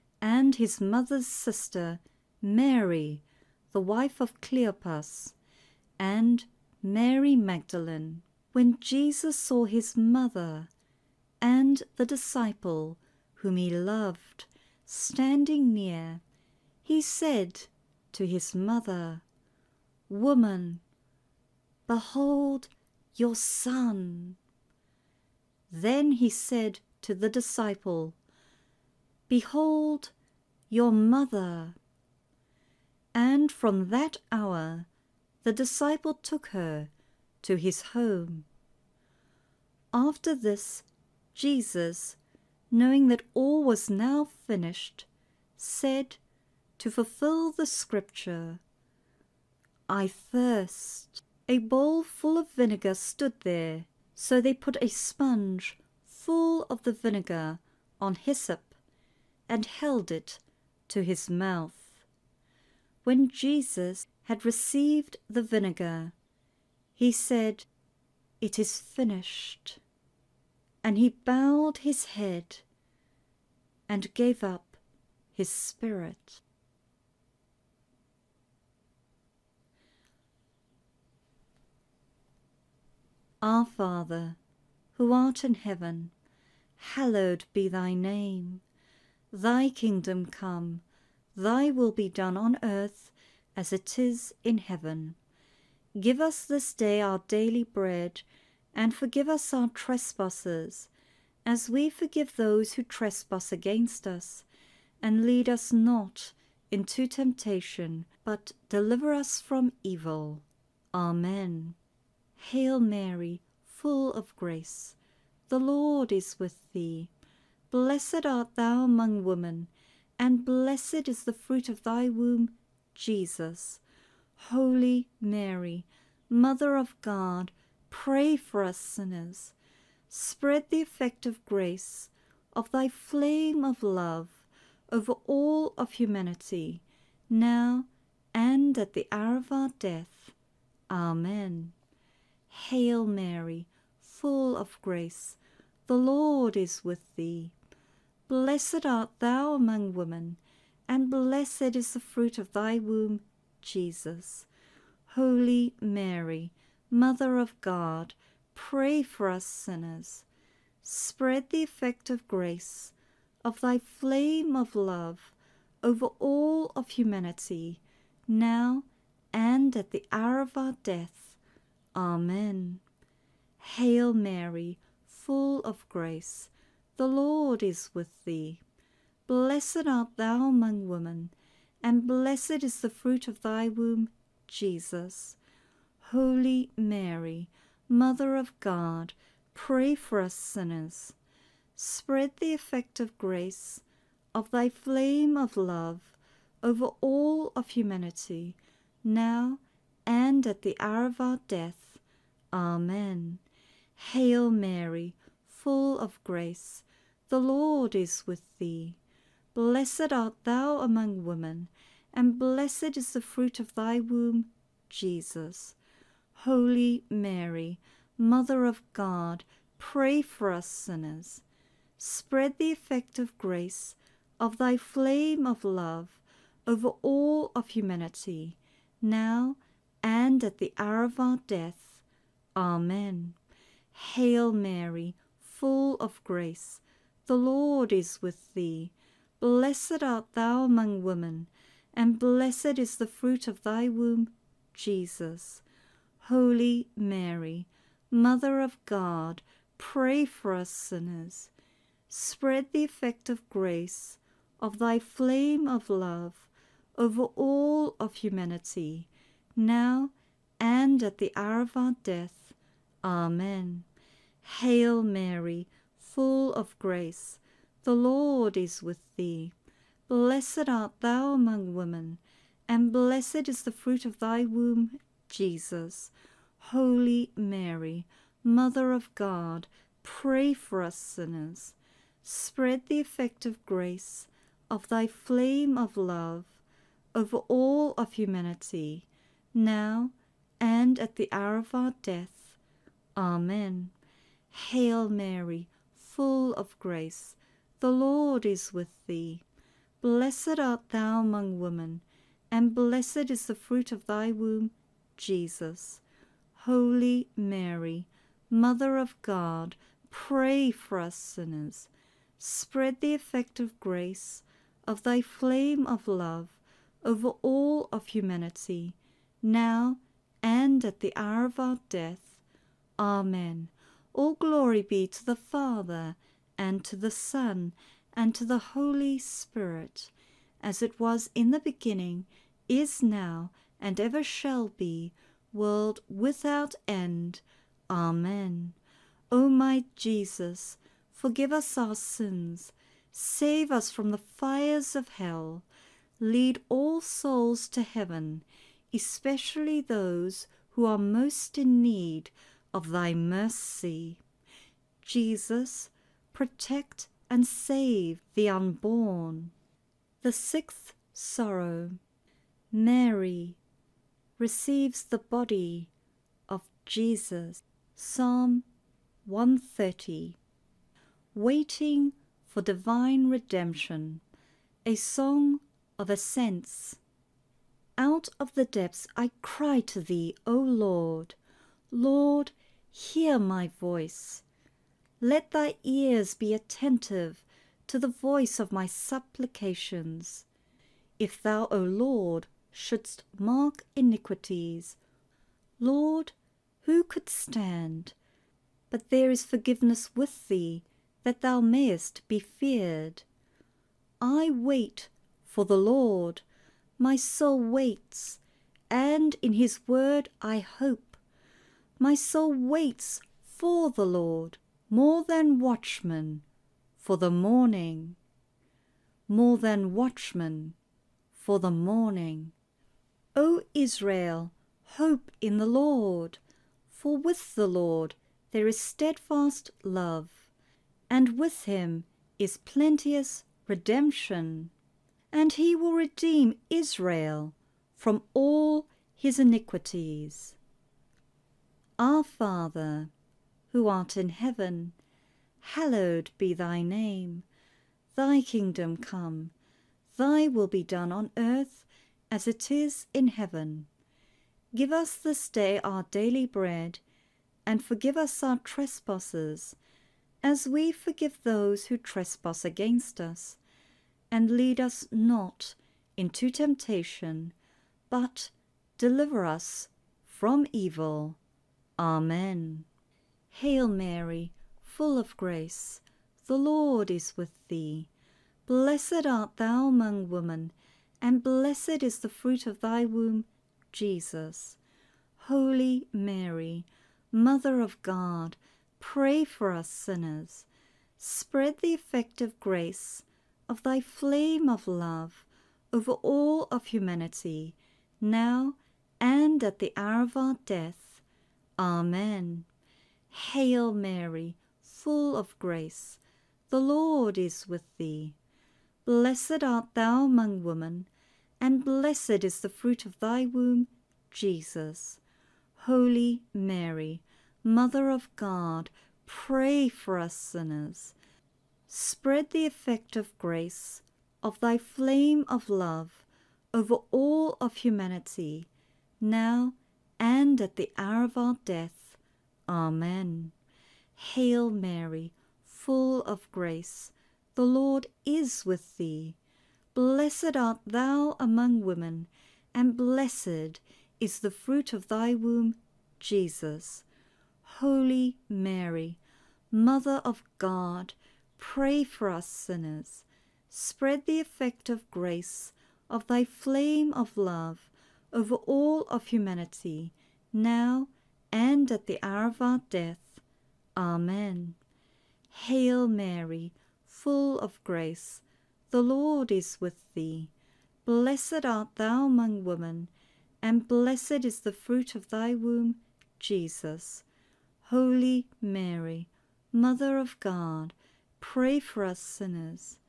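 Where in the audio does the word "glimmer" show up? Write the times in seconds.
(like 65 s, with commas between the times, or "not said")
not said.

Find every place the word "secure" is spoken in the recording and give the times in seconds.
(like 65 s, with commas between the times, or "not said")
not said.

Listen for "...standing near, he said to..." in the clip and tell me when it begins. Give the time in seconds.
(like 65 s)
14 s.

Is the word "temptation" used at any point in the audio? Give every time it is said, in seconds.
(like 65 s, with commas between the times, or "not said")
107 s, 466 s.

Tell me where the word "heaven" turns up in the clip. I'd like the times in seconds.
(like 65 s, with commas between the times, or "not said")
85 s, 94 s, 347 s, 444 s, 453 s.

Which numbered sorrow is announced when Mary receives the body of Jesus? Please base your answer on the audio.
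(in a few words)
The sixth.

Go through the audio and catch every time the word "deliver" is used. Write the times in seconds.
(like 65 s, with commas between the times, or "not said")
108 s, 468 s.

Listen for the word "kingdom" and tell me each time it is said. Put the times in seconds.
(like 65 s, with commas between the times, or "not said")
89 s, 448 s.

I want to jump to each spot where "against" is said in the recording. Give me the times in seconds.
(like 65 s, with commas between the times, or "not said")
103 s, 462 s.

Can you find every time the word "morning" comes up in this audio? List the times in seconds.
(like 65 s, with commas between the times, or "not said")
417 s, 421 s.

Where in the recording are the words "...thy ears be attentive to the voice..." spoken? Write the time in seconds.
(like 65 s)
385 s.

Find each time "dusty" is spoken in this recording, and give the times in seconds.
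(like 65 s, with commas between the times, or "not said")
not said.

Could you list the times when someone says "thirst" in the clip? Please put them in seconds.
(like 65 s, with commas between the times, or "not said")
50 s.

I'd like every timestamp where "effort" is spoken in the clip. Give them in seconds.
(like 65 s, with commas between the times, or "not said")
not said.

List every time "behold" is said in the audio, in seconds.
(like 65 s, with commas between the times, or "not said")
21 s, 29 s.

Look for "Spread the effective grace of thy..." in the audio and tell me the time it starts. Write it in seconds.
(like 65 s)
282 s.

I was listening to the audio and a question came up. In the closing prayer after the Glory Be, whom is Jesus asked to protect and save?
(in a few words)
the unborn.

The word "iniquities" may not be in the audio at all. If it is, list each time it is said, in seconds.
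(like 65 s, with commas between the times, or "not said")
393 s, 439 s.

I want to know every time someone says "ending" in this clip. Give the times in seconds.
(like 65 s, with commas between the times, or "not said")
not said.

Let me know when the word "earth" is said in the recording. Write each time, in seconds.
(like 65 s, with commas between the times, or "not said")
92 s, 451 s.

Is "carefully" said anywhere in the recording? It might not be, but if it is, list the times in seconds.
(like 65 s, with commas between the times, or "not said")
not said.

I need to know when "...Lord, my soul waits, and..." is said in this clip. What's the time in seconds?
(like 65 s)
405 s.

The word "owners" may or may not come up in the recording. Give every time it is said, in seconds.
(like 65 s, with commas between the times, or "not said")
not said.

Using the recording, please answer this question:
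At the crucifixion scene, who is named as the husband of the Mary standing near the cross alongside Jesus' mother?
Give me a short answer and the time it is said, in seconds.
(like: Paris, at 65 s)
Cleopas, at 4 s.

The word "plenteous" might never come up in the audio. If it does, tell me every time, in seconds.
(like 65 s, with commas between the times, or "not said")
432 s.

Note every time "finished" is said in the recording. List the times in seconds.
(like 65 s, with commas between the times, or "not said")
44 s, 68 s.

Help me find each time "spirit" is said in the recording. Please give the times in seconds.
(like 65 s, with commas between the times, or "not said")
75 s, 329 s.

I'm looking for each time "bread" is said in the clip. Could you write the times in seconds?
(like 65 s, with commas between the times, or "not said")
97 s, 456 s.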